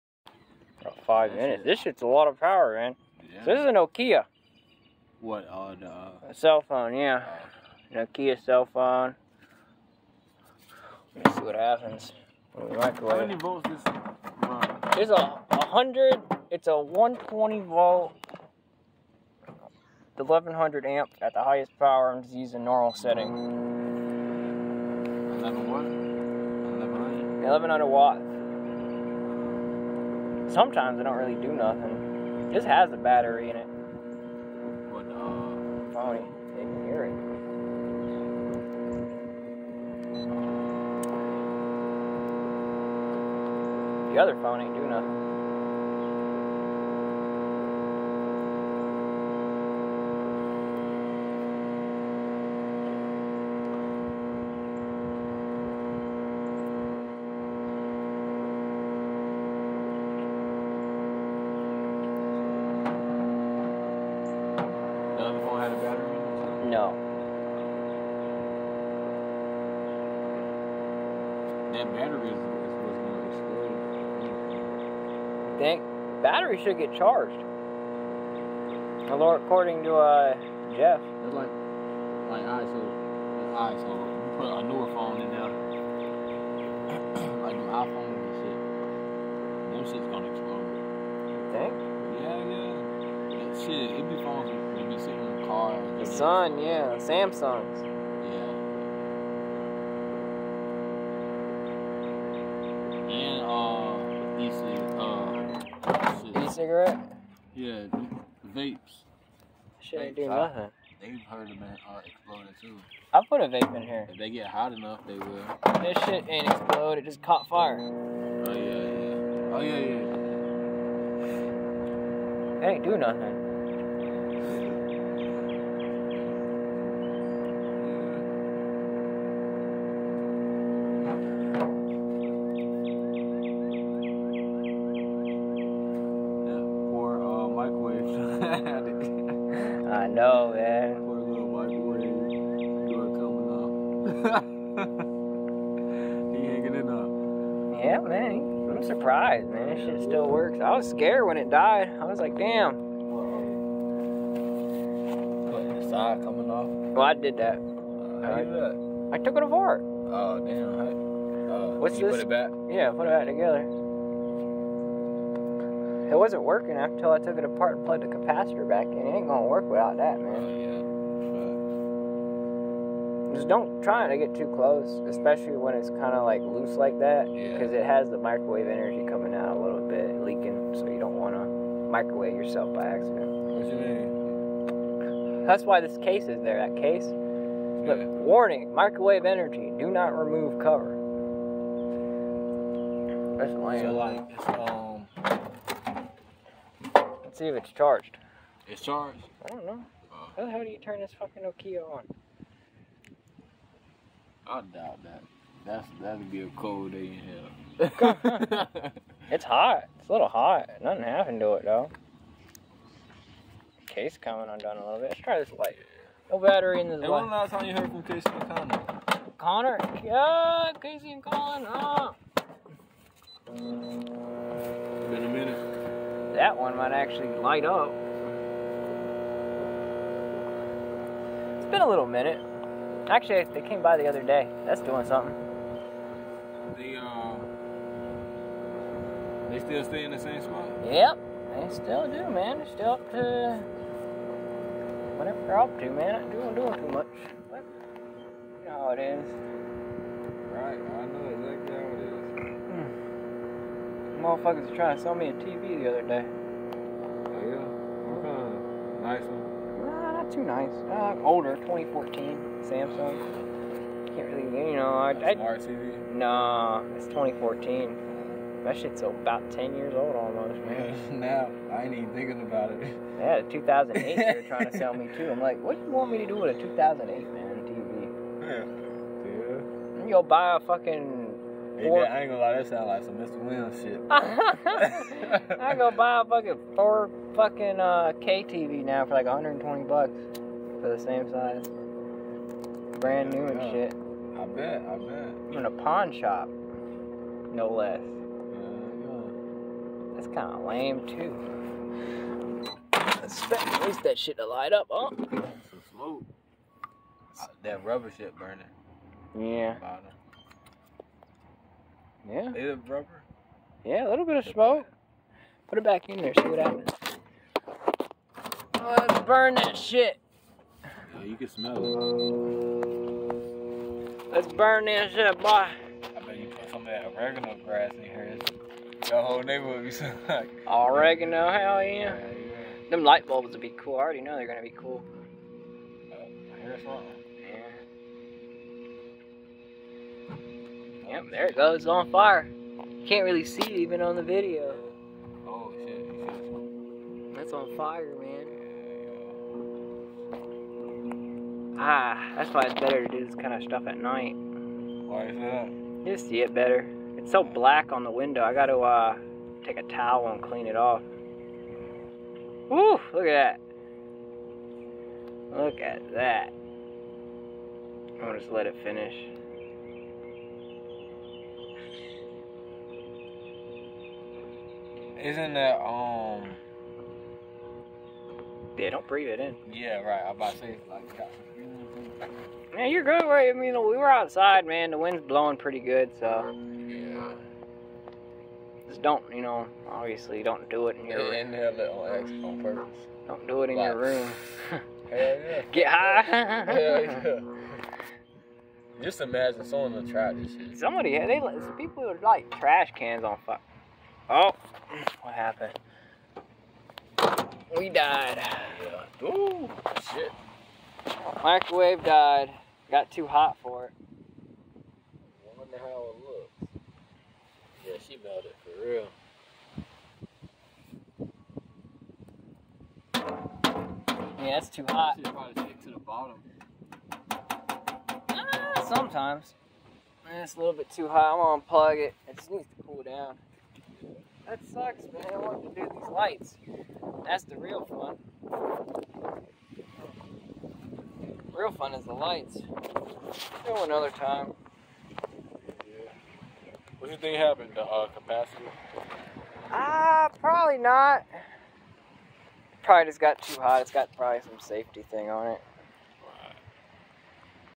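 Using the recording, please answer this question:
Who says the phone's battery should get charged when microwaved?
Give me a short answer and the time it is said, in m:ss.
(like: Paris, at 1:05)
Jeff, at 1:19.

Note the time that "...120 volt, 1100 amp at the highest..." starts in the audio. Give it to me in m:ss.
0:16.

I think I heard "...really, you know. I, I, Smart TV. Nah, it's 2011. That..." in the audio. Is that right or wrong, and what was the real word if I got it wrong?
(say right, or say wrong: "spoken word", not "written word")
wrong: "2014", not "2011".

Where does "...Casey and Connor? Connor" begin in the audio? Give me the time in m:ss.
3:38.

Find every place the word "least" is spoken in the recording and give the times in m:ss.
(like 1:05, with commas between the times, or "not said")
5:03.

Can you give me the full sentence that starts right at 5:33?
I already know they're gonna be cool.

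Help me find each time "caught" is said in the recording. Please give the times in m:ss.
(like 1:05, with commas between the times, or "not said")
1:57.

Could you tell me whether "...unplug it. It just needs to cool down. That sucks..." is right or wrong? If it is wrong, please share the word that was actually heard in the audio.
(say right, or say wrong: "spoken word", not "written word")
right.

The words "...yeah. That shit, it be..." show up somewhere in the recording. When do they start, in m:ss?
1:32.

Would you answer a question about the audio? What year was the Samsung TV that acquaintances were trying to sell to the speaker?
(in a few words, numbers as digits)
2014.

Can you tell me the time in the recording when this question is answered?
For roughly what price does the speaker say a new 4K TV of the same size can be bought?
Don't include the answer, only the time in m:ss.
4:49.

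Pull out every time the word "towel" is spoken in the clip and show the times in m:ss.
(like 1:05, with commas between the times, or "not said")
5:59.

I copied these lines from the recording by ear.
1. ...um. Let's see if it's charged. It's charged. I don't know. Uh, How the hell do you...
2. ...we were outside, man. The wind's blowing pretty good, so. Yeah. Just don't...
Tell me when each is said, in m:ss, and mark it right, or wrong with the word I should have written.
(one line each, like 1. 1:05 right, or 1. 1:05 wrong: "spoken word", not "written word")
1. 3:15 right
2. 6:23 right.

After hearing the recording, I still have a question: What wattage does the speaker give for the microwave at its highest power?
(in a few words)
1100.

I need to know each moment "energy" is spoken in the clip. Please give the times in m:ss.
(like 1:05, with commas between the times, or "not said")
2:58, 3:09.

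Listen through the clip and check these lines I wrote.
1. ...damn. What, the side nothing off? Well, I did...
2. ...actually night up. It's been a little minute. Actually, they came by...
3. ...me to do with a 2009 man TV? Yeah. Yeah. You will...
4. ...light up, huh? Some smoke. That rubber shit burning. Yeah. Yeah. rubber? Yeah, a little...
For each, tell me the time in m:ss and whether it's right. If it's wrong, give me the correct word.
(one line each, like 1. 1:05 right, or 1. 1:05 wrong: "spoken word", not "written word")
1. 2:32 wrong: "coming", not "nothing"
2. 3:46 wrong: "light", not "night"
3. 4:36 wrong: "2008", not "2009"
4. 5:04 right.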